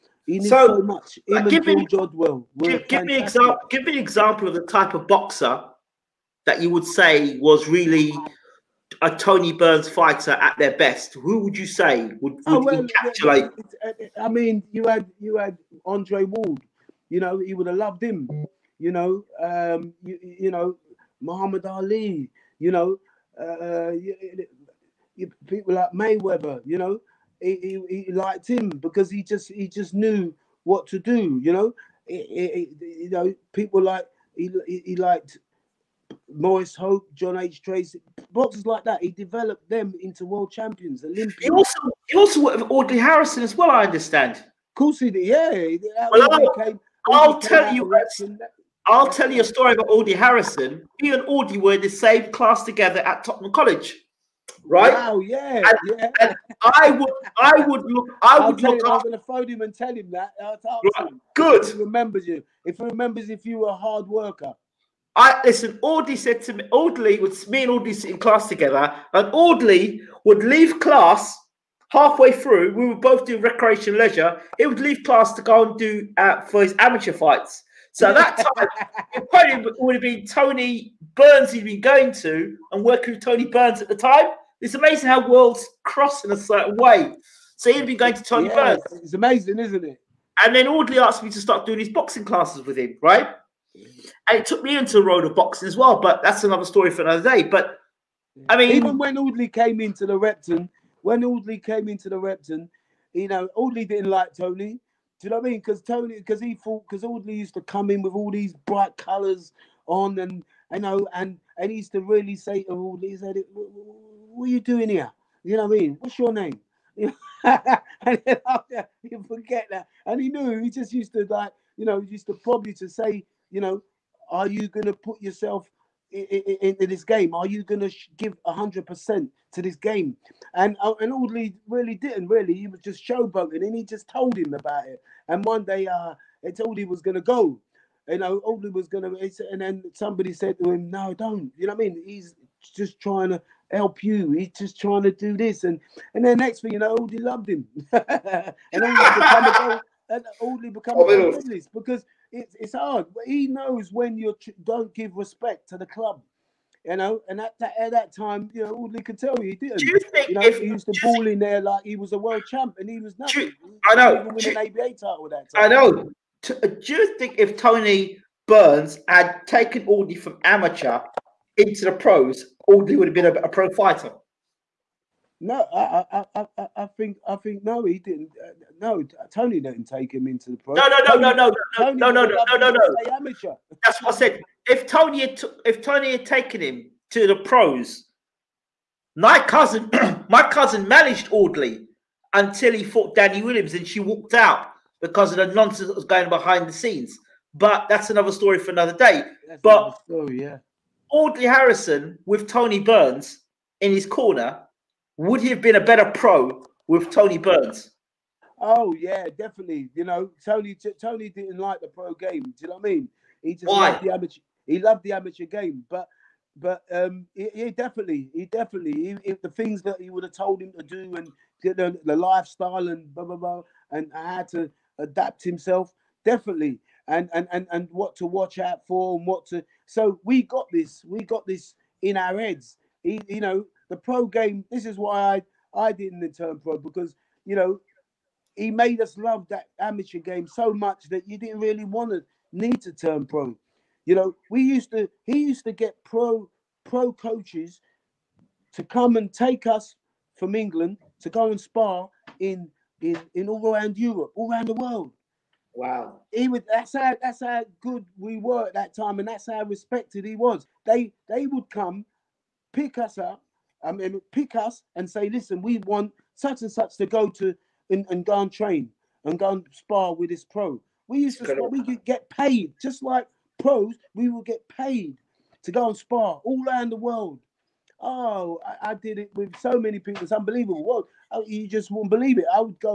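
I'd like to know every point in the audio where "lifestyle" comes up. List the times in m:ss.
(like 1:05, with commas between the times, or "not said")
3:42.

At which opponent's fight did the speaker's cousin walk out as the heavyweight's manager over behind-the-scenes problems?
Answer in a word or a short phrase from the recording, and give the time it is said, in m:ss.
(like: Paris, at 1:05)
Danny Williams, at 3:13.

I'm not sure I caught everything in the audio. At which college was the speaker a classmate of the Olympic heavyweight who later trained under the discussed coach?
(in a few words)
Tottenham College.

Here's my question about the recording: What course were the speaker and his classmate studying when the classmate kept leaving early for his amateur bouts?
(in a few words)
recreation leisure.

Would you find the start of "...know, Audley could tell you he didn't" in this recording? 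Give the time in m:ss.
2:38.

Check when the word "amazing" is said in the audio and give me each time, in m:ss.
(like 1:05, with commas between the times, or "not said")
1:24, 1:29.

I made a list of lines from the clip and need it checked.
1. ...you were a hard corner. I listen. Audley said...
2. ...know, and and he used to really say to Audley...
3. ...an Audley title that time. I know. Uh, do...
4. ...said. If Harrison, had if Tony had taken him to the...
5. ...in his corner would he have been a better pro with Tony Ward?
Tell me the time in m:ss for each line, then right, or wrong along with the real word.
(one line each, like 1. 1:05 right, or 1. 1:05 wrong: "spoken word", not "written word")
1. 1:03 wrong: "worker", not "corner"
2. 1:50 right
3. 2:44 wrong: "ABA", not "Audley"
4. 3:04 wrong: "Tony", not "Harrison"
5. 3:23 wrong: "Burns", not "Ward".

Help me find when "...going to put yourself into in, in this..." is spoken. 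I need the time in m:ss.
2:04.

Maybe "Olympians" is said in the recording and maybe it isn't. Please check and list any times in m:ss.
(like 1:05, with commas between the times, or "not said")
0:41.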